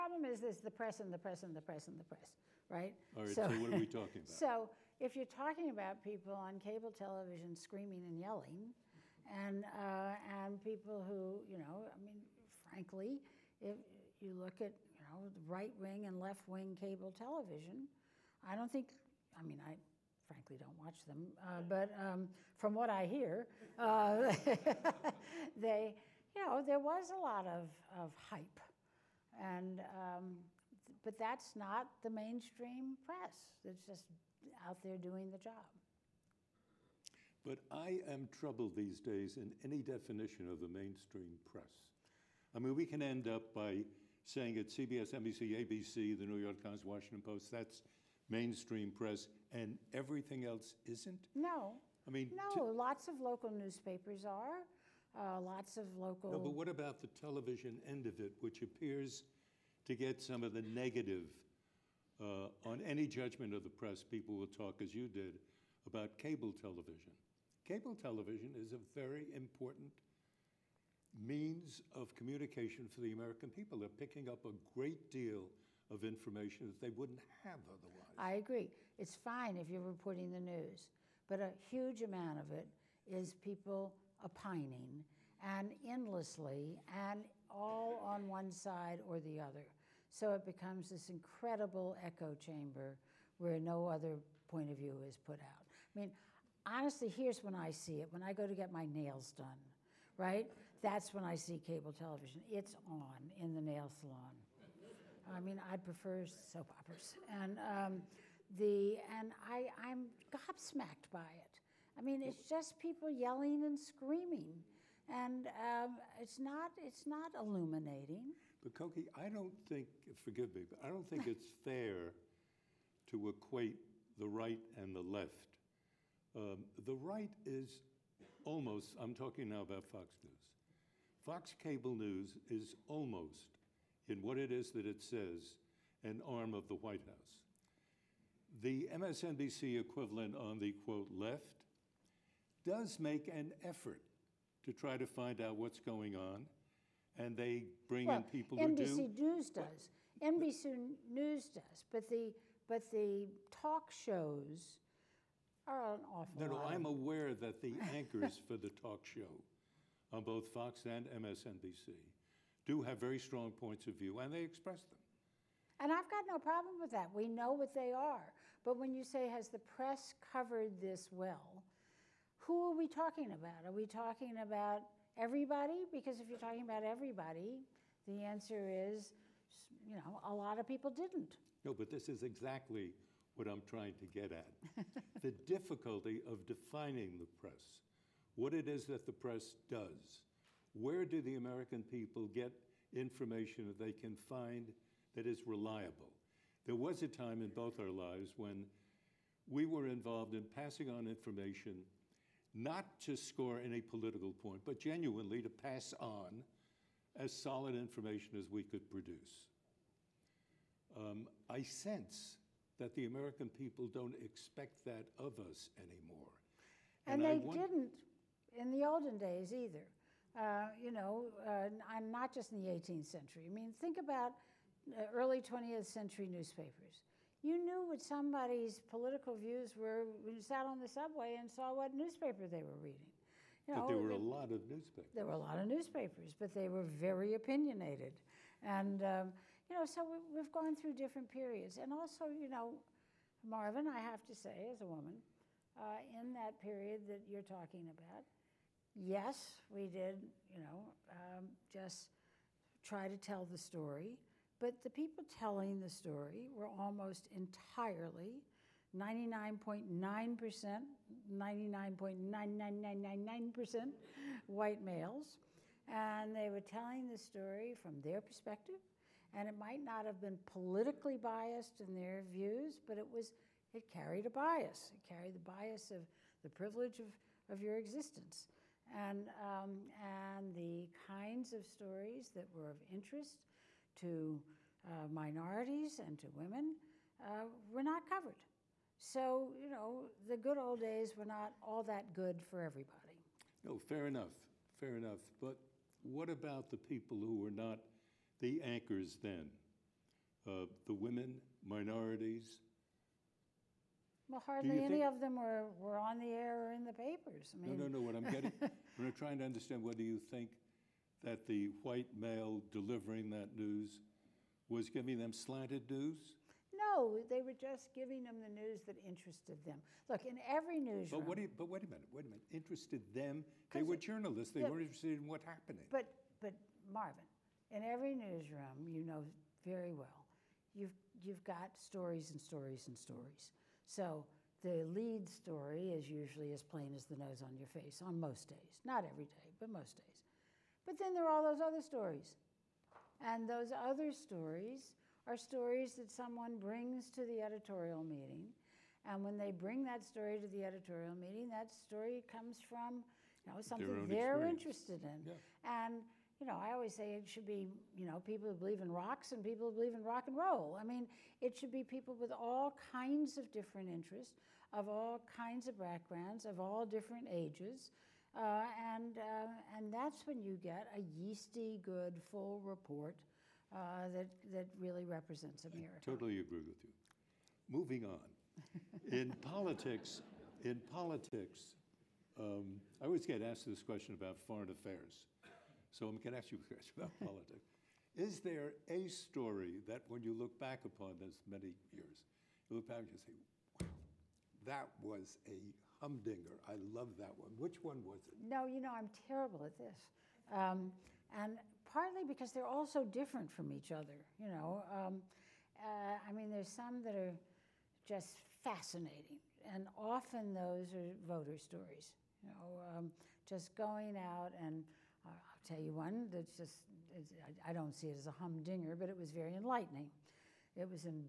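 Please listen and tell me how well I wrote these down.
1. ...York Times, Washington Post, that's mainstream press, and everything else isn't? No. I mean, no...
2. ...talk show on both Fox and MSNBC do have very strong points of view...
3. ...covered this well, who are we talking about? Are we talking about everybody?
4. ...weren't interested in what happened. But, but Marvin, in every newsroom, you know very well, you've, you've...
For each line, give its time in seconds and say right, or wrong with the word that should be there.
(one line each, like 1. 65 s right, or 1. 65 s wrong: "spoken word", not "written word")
1. 46 s right
2. 158 s right
3. 170 s right
4. 324 s right.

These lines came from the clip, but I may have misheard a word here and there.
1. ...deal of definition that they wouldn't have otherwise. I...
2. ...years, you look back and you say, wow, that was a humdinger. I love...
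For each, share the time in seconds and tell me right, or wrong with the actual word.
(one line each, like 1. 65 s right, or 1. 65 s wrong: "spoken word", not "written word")
1. 75 s wrong: "information", not "definition"
2. 391 s right.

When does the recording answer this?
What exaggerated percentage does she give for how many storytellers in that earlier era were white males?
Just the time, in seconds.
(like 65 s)
261 s.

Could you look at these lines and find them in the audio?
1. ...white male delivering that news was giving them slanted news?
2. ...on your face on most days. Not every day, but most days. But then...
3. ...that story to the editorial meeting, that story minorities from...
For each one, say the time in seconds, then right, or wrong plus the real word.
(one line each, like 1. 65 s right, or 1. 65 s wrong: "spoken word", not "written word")
1. 311 s right
2. 337 s right
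3. 349 s wrong: "comes", not "minorities".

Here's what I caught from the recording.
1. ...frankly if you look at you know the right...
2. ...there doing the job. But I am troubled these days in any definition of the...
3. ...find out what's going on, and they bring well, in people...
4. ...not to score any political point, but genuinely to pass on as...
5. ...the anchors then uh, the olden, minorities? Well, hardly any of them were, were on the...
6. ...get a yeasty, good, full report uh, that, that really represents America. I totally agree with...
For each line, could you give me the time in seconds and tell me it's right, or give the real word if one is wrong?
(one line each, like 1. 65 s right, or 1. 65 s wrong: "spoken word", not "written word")
1. 12 s right
2. 34 s right
3. 145 s right
4. 202 s right
5. 298 s wrong: "women", not "olden"
6. 370 s right.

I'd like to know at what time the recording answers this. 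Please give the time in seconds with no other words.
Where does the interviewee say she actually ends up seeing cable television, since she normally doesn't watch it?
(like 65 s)
103 s.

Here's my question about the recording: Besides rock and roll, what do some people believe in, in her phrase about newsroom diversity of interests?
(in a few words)
Rocks.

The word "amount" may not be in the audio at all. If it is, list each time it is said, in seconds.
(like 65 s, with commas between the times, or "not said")
82 s.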